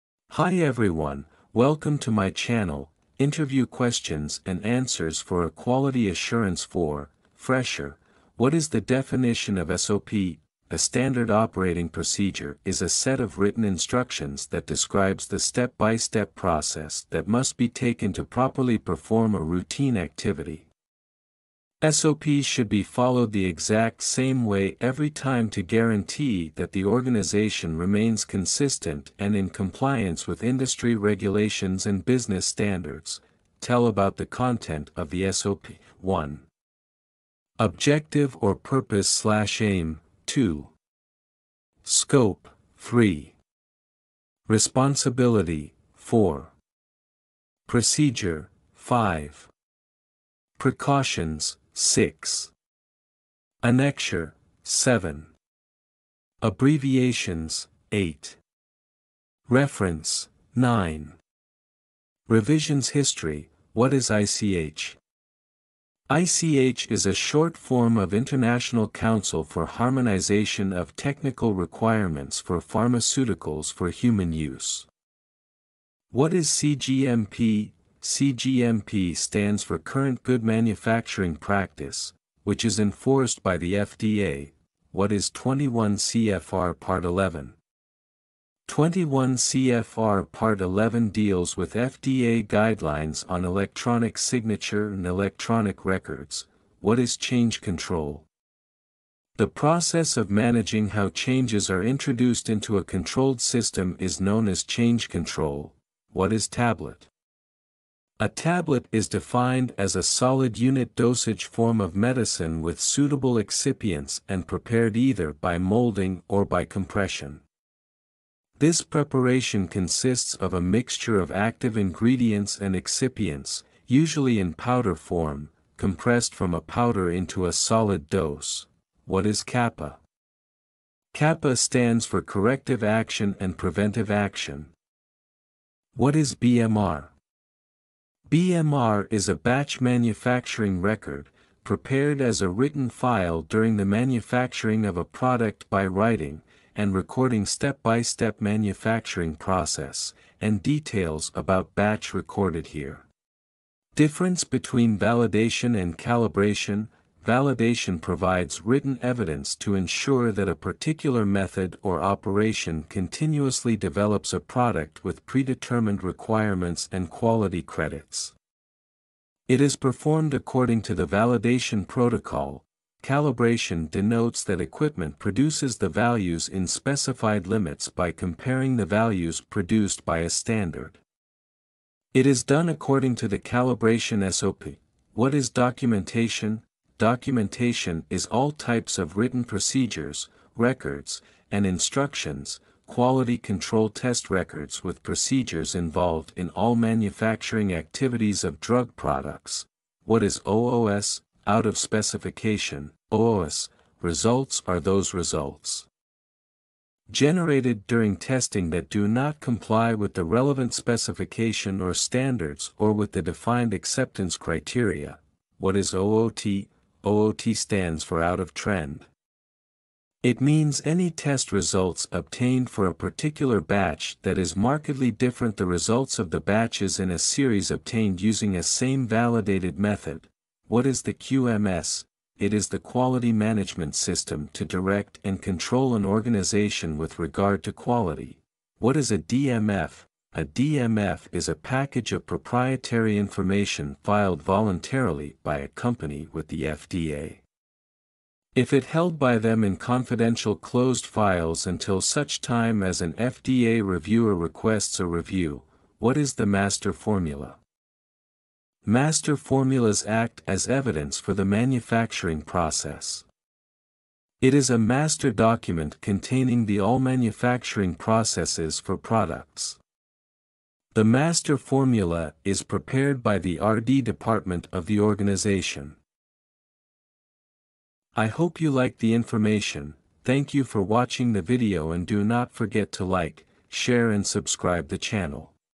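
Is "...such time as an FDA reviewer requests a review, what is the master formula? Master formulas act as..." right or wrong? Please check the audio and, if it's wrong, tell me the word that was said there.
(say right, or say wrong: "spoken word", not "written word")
right.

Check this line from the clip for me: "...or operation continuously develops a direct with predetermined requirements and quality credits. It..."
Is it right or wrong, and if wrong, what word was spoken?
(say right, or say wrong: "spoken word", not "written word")
wrong: "product", not "direct".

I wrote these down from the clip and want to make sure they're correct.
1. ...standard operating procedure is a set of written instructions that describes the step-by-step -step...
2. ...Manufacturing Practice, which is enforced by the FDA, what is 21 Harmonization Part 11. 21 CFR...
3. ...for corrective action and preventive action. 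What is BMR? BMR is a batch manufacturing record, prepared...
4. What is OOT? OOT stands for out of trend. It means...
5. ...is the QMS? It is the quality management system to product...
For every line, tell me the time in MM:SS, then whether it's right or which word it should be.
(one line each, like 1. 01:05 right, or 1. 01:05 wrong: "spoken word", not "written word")
1. 00:10 right
2. 01:20 wrong: "CFR", not "Harmonization"
3. 02:12 right
4. 03:35 right
5. 03:50 wrong: "direct", not "product".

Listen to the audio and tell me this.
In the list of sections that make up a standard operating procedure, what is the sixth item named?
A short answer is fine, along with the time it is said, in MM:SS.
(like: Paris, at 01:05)
Annexure, at 00:53.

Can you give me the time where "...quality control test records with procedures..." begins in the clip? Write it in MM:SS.
03:12.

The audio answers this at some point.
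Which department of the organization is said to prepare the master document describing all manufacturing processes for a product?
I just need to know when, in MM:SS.
04:33.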